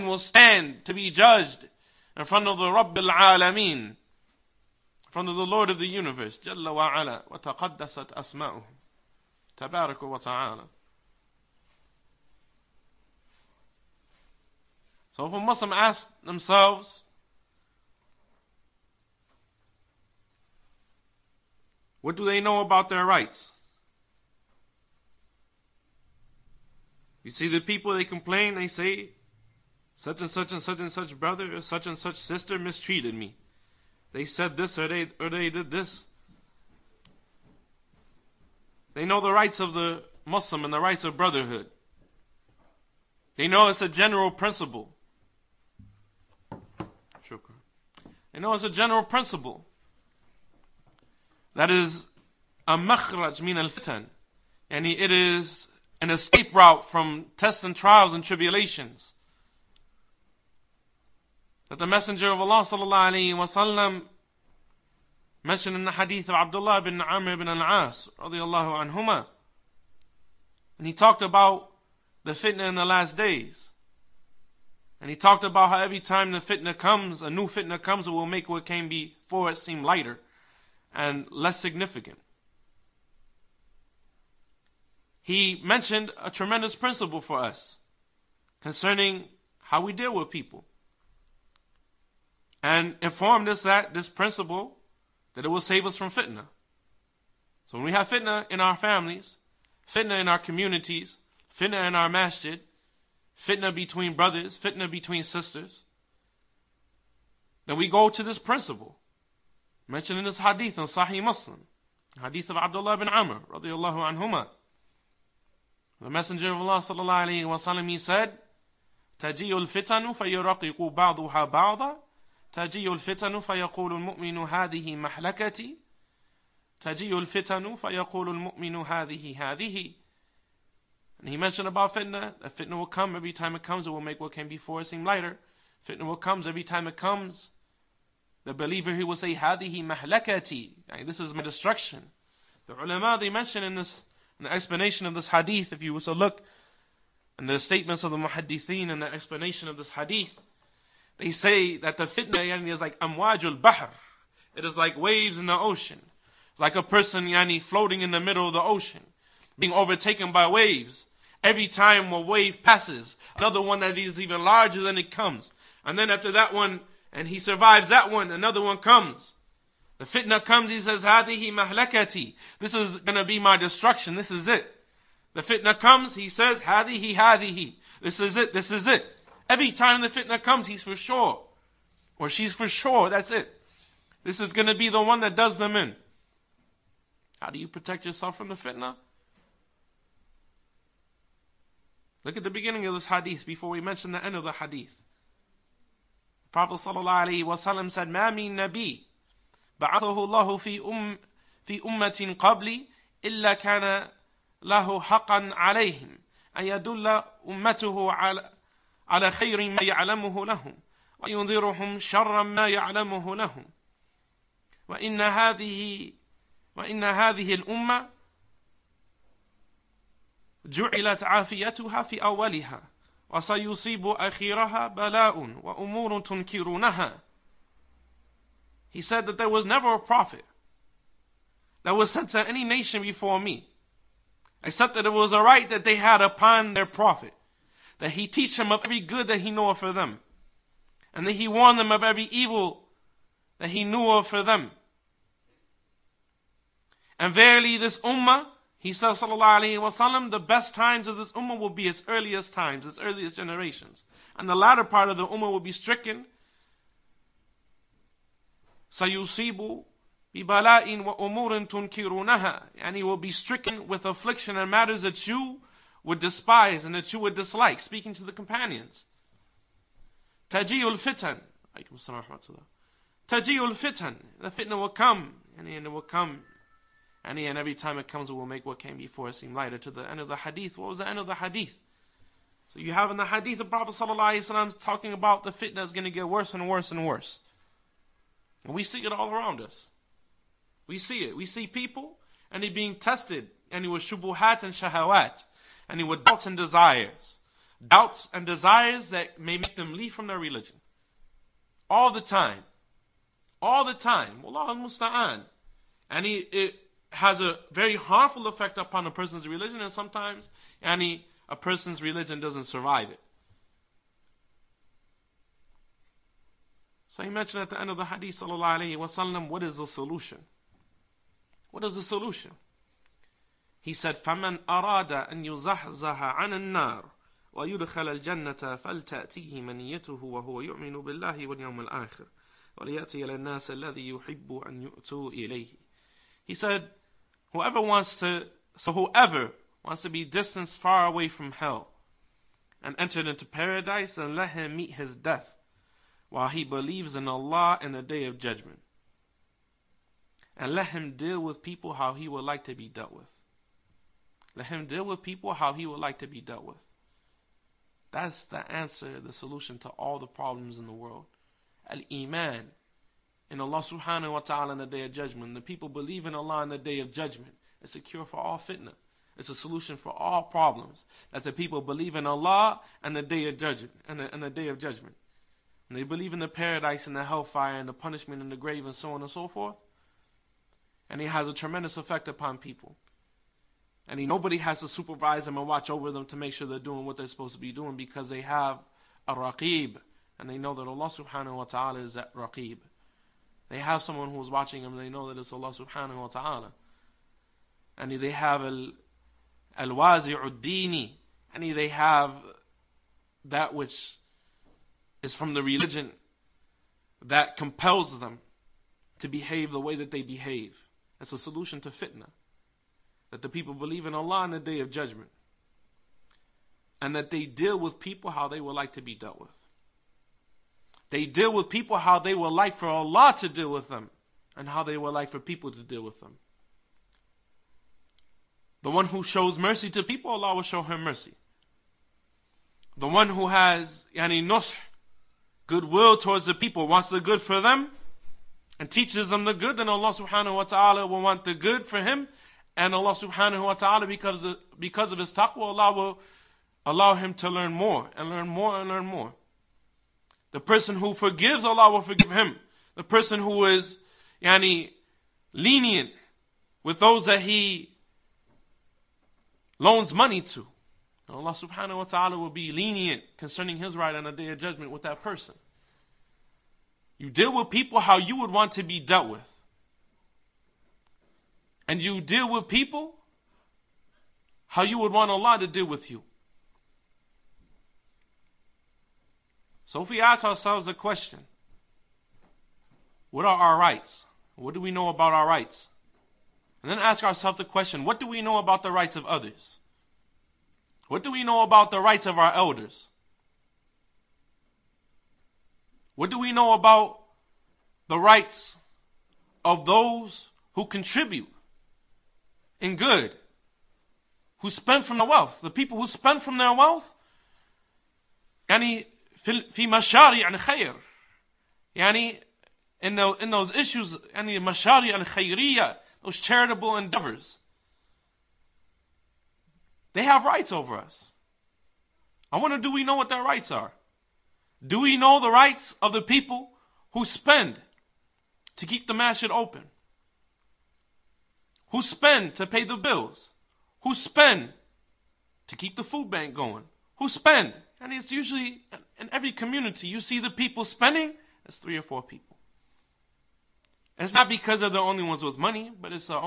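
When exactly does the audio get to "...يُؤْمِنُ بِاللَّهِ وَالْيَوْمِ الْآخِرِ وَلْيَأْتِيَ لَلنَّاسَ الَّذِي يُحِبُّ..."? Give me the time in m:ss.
5:30.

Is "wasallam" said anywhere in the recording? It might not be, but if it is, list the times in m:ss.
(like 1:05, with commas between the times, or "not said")
1:03, 4:09, 5:18.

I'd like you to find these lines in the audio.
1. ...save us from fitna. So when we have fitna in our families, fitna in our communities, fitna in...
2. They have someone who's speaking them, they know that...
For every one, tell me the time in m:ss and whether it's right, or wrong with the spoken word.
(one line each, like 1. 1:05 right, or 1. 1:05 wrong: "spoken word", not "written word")
1. 1:35 right
2. 6:33 wrong: "watching", not "speaking".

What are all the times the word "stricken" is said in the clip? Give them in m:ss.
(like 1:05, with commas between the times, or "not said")
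4:15, 4:23.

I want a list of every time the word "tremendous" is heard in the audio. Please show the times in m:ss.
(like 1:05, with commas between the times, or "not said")
1:26, 6:21.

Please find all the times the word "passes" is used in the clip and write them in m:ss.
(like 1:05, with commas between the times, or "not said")
2:42.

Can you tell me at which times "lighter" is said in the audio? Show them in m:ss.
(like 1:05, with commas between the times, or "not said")
1:19, 2:15, 4:39.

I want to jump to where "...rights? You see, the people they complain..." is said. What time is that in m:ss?
0:23.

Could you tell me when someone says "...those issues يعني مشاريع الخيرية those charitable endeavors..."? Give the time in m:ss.
8:33.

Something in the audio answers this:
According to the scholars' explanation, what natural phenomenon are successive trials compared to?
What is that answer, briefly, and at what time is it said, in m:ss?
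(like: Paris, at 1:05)
waves in the ocean, at 2:34.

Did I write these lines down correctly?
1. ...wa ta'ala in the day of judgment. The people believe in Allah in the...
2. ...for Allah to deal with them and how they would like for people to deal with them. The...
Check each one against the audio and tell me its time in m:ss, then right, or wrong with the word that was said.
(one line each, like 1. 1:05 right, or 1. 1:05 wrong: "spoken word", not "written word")
1. 6:04 right
2. 7:02 right.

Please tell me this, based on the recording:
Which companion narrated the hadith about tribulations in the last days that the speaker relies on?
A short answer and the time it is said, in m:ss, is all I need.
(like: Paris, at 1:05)
Abdullah bin Amr ibn al-As, at 1:06.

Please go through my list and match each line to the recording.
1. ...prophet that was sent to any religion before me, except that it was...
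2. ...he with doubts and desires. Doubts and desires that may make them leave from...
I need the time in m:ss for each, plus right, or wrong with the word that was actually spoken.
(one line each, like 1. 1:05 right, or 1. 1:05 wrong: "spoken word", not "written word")
1. 3:49 wrong: "nation", not "religion"
2. 4:55 right.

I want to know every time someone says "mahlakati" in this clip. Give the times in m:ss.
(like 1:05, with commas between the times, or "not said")
2:19, 2:51.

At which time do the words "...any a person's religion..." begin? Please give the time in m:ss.
5:10.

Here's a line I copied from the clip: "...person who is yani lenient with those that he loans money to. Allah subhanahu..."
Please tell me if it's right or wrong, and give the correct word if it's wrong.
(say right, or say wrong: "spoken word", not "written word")
right.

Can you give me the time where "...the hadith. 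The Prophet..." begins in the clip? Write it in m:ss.
3:14.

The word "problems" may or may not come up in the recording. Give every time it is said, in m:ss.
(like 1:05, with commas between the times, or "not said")
6:00, 6:10.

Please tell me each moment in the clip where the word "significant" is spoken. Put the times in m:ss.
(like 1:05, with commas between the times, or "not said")
1:21.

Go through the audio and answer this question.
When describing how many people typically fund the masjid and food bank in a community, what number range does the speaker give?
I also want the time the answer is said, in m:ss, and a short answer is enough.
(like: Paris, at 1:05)
3 or 4, at 9:01.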